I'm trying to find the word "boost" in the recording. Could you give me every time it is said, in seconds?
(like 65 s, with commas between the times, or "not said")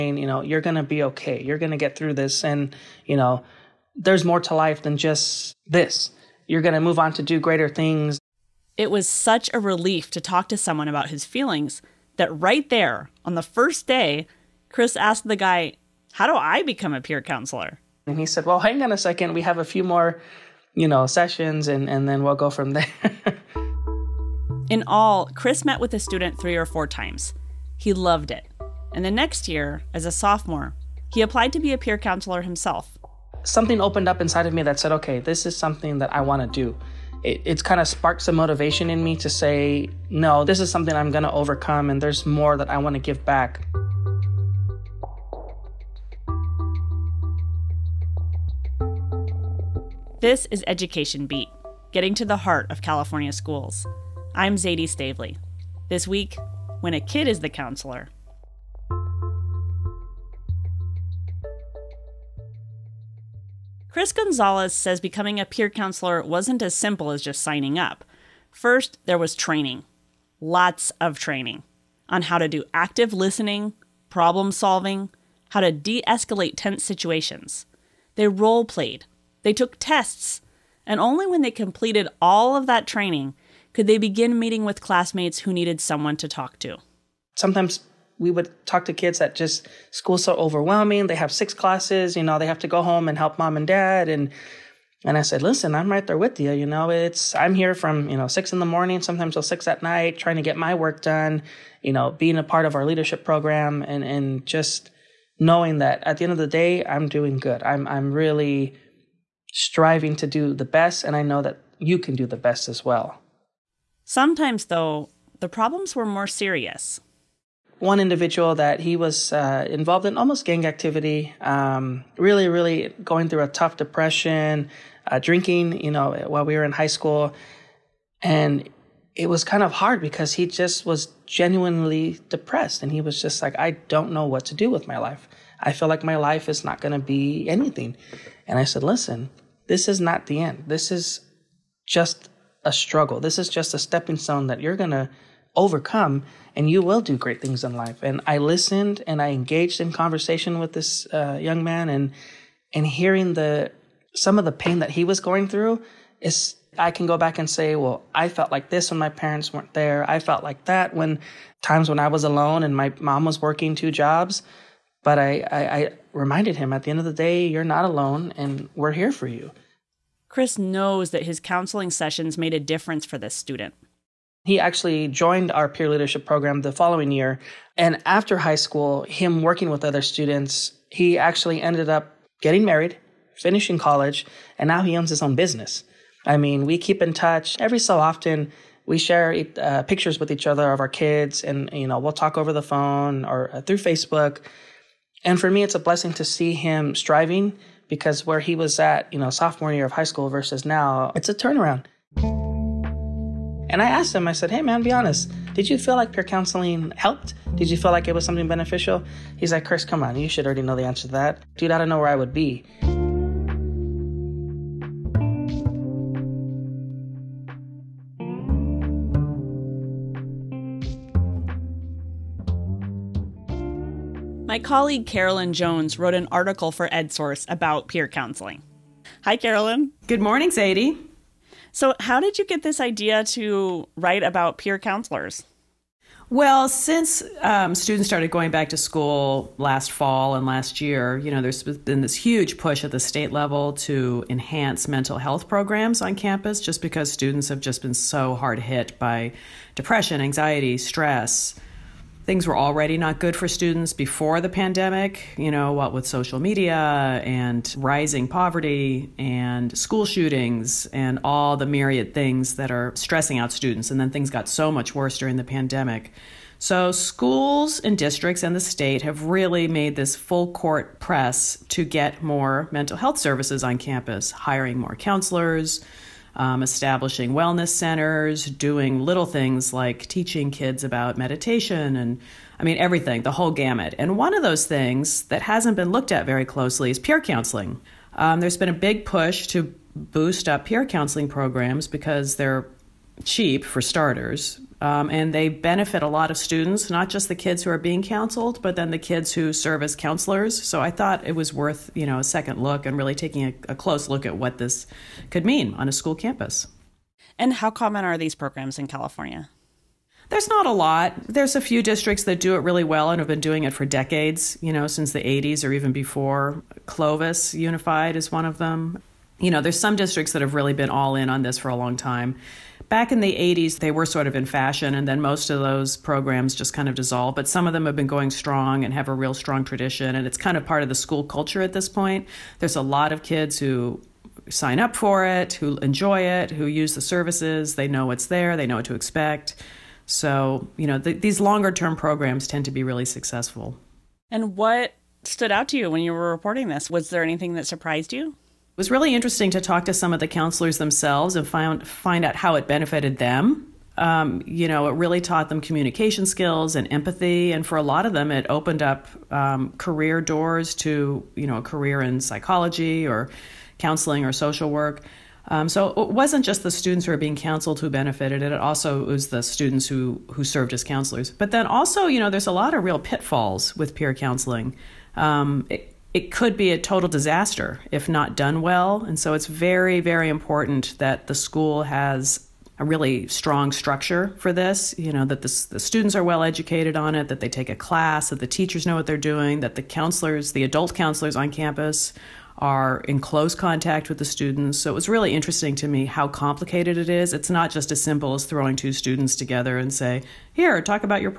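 289 s.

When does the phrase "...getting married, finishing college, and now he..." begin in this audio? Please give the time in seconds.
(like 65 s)
182 s.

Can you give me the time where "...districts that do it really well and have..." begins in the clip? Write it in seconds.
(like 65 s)
311 s.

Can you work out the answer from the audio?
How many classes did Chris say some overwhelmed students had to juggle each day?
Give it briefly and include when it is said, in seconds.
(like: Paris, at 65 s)
6, at 91 s.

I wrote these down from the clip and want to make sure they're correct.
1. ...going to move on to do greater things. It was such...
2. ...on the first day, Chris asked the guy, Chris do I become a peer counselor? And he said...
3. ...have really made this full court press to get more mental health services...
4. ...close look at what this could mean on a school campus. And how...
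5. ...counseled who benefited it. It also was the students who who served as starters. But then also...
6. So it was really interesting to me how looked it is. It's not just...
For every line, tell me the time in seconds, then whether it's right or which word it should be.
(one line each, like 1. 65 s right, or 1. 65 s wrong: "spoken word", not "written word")
1. 6 s right
2. 13 s wrong: "How", not "Chris"
3. 269 s right
4. 303 s right
5. 367 s wrong: "counselors", not "starters"
6. 394 s wrong: "complicated", not "looked".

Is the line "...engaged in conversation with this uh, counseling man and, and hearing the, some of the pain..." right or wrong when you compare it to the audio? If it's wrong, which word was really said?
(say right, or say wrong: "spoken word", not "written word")
wrong: "young", not "counseling".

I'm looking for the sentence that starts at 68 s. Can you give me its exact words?
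First, there was training, lots of training on how to do active listening, problem solving, how to de escalate tense situations.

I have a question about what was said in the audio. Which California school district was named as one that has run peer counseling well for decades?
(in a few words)
Clovis Unified.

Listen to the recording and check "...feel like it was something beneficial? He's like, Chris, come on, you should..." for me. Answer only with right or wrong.
right.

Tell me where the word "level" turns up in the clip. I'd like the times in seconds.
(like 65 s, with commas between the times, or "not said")
243 s.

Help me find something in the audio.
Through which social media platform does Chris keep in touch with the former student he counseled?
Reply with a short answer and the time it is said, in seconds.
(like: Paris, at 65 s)
Facebook, at 193 s.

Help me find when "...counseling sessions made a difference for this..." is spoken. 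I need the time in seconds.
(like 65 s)
171 s.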